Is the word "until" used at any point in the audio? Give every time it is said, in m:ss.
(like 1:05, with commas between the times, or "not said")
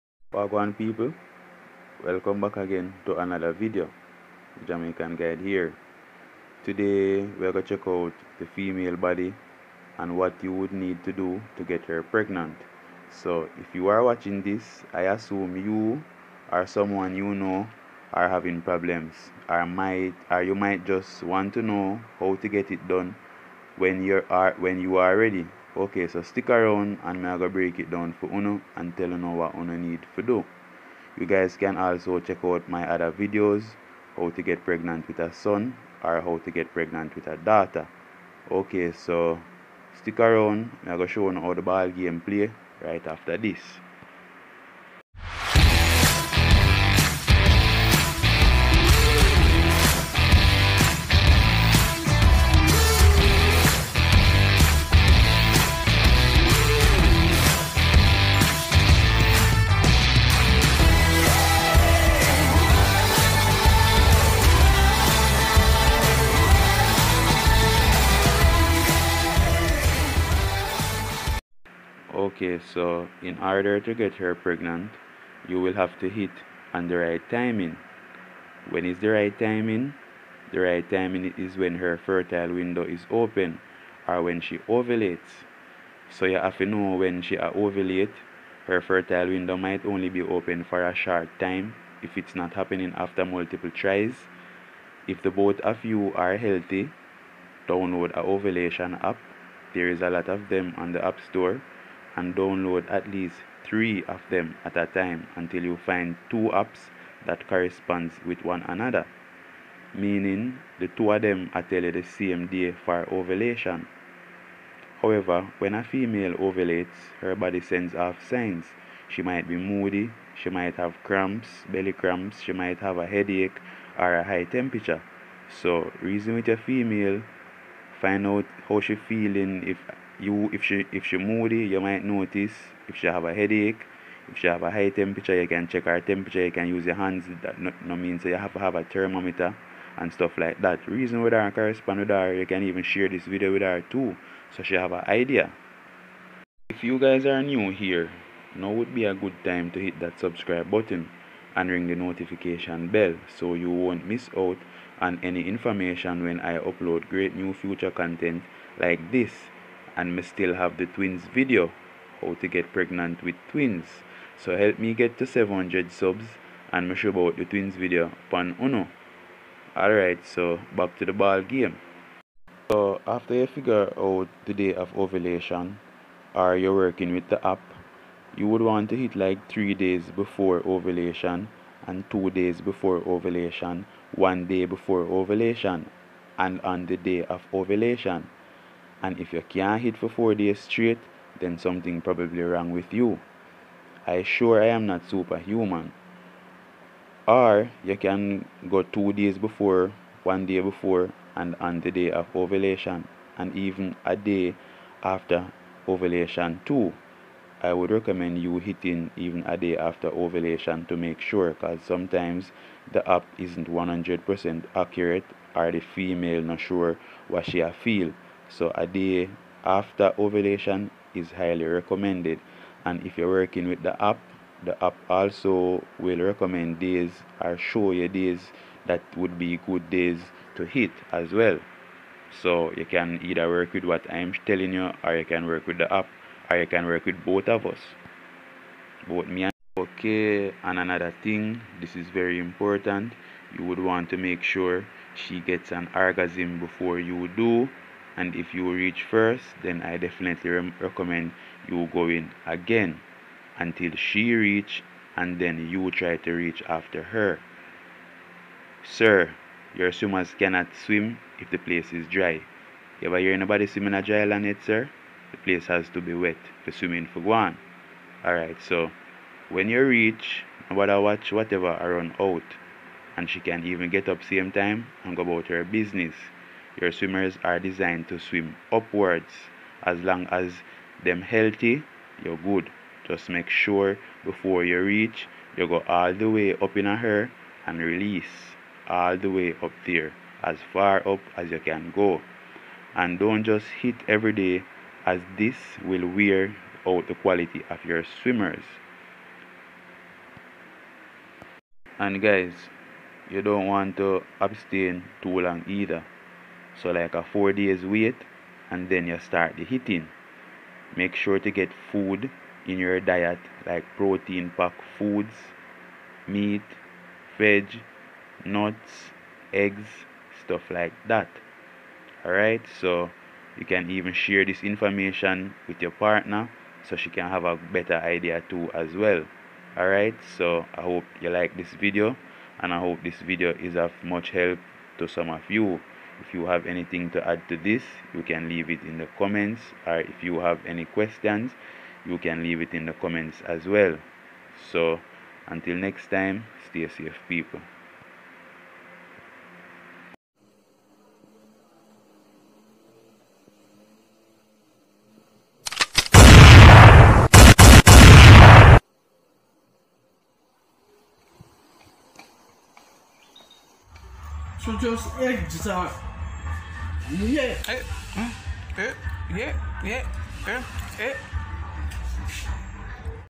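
1:45, 4:13, 5:45.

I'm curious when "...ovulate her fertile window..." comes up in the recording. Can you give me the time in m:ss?
1:27.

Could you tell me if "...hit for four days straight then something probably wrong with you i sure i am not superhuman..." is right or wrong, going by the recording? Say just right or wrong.
right.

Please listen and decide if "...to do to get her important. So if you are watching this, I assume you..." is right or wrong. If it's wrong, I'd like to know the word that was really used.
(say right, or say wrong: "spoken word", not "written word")
wrong: "pregnant", not "important".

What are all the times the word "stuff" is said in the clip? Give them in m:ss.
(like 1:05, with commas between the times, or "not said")
2:20, 5:20.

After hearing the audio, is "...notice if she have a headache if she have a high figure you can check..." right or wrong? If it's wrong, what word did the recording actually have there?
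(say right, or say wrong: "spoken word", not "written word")
wrong: "temperature", not "figure".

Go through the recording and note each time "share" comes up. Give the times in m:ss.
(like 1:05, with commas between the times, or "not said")
2:22, 5:24.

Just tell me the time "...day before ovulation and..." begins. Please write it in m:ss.
3:04.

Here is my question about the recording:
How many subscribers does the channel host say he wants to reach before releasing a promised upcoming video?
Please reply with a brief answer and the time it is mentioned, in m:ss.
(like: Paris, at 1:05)
700, at 2:45.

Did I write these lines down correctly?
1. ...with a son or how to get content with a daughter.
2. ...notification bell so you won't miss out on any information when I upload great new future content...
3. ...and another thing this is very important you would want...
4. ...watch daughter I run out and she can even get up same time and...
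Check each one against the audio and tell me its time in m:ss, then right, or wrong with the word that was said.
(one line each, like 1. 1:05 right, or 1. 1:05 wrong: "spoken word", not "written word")
1. 0:35 wrong: "pregnant", not "content"
2. 2:31 right
3. 4:00 right
4. 4:31 wrong: "whatever", not "daughter".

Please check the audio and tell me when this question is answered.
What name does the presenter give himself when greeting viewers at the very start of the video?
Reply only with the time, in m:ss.
0:04.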